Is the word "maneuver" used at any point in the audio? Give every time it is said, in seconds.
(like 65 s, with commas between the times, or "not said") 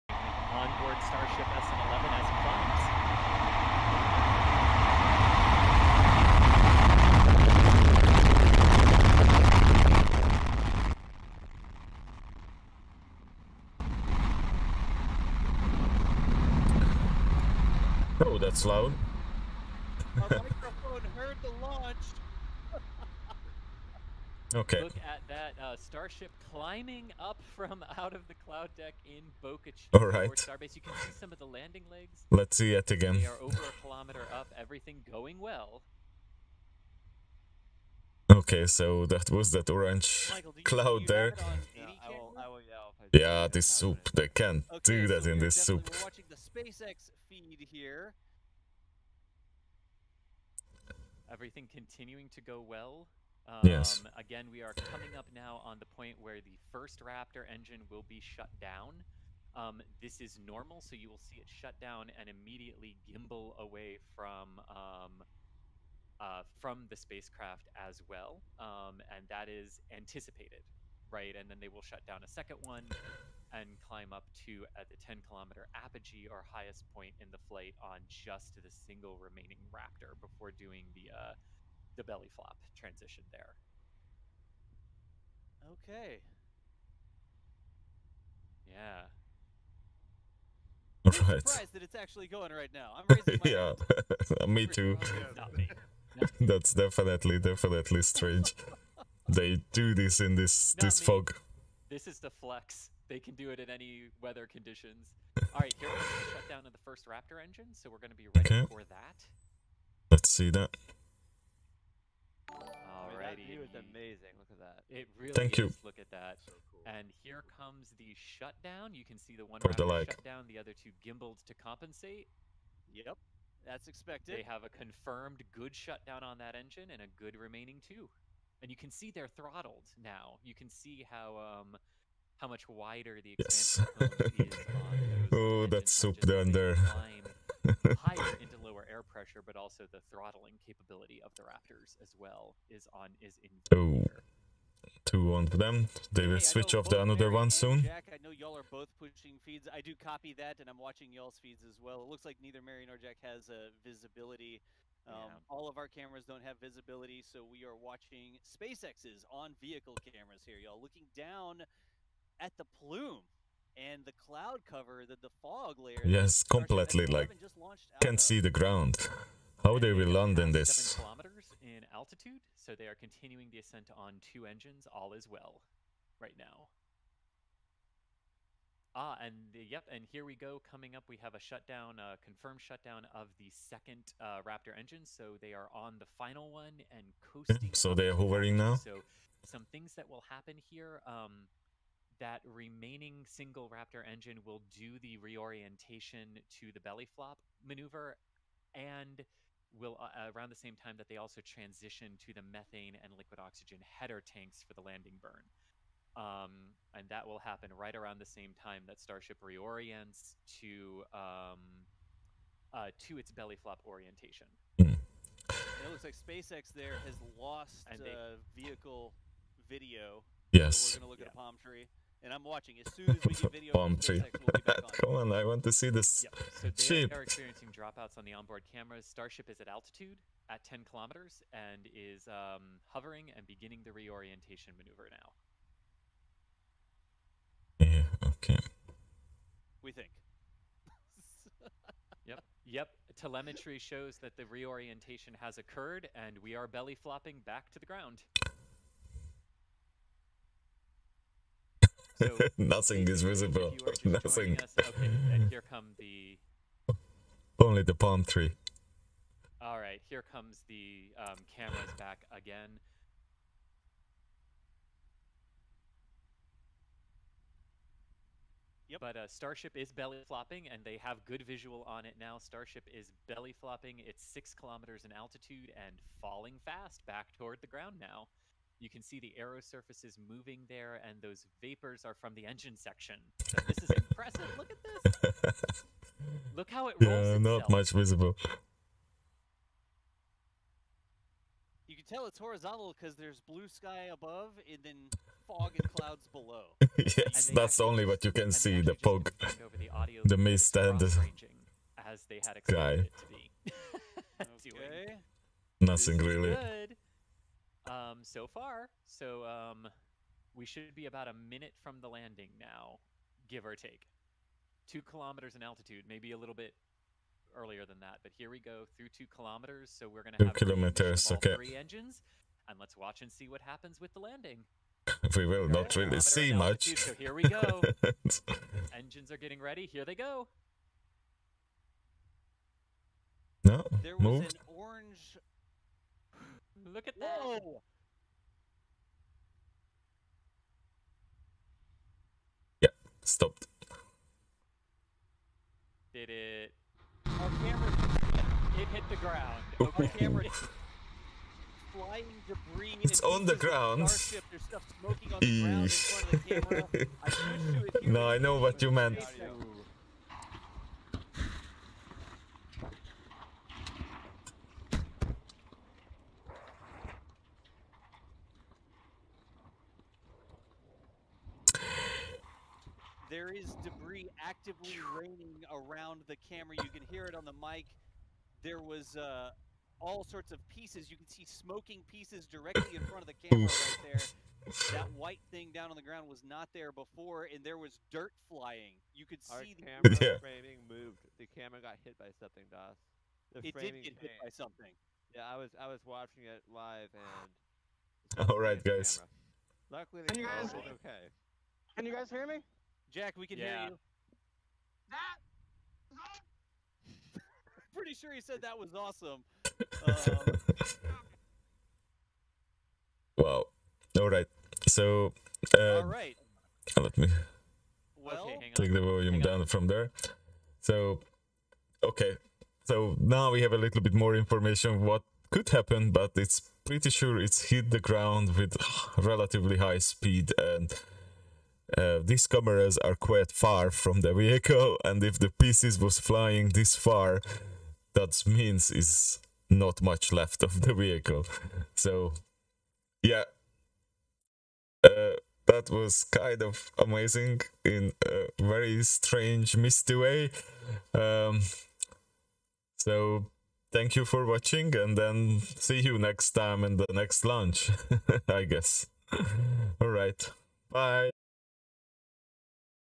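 197 s, 234 s.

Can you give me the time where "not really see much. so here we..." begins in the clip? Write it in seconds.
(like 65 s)
325 s.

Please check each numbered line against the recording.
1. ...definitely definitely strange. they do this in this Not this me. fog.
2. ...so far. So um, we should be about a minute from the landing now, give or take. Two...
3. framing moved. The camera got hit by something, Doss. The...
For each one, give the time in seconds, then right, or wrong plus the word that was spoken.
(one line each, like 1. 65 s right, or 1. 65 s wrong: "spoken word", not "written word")
1. 96 s right
2. 308 s right
3. 390 s right.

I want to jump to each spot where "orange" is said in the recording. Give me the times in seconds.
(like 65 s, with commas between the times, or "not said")
39 s, 334 s.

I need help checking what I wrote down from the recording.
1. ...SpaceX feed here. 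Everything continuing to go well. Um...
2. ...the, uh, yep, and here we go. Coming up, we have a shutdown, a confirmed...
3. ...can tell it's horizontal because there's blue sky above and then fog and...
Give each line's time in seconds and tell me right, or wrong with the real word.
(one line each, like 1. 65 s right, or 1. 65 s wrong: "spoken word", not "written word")
1. 46 s right
2. 179 s right
3. 291 s right.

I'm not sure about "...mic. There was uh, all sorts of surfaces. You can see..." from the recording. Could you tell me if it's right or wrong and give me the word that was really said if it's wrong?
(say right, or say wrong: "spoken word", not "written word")
wrong: "pieces", not "surfaces".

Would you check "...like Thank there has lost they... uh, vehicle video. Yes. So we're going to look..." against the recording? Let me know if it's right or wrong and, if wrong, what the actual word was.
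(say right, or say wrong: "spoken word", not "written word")
wrong: "SpaceX", not "Thank".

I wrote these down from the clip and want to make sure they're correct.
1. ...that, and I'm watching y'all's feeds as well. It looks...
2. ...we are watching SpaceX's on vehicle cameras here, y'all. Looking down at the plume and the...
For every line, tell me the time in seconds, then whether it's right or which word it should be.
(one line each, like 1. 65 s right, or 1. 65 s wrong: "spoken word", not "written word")
1. 150 s right
2. 157 s right.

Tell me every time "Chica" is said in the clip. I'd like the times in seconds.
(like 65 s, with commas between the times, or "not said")
29 s.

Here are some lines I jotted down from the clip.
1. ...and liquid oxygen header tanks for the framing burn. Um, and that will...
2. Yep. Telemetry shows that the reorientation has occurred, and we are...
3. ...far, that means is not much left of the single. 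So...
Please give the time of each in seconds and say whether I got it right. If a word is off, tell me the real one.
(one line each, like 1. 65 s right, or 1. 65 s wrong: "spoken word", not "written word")
1. 203 s wrong: "landing", not "framing"
2. 242 s right
3. 436 s wrong: "vehicle", not "single".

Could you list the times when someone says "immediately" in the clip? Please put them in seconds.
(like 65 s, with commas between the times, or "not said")
62 s.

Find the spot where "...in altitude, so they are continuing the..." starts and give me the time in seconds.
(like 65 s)
171 s.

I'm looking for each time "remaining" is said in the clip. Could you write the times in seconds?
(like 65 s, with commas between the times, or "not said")
79 s, 127 s, 192 s.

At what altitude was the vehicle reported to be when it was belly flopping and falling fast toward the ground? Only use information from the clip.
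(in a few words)
6 kilometers.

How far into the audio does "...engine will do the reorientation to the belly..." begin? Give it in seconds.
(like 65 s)
194 s.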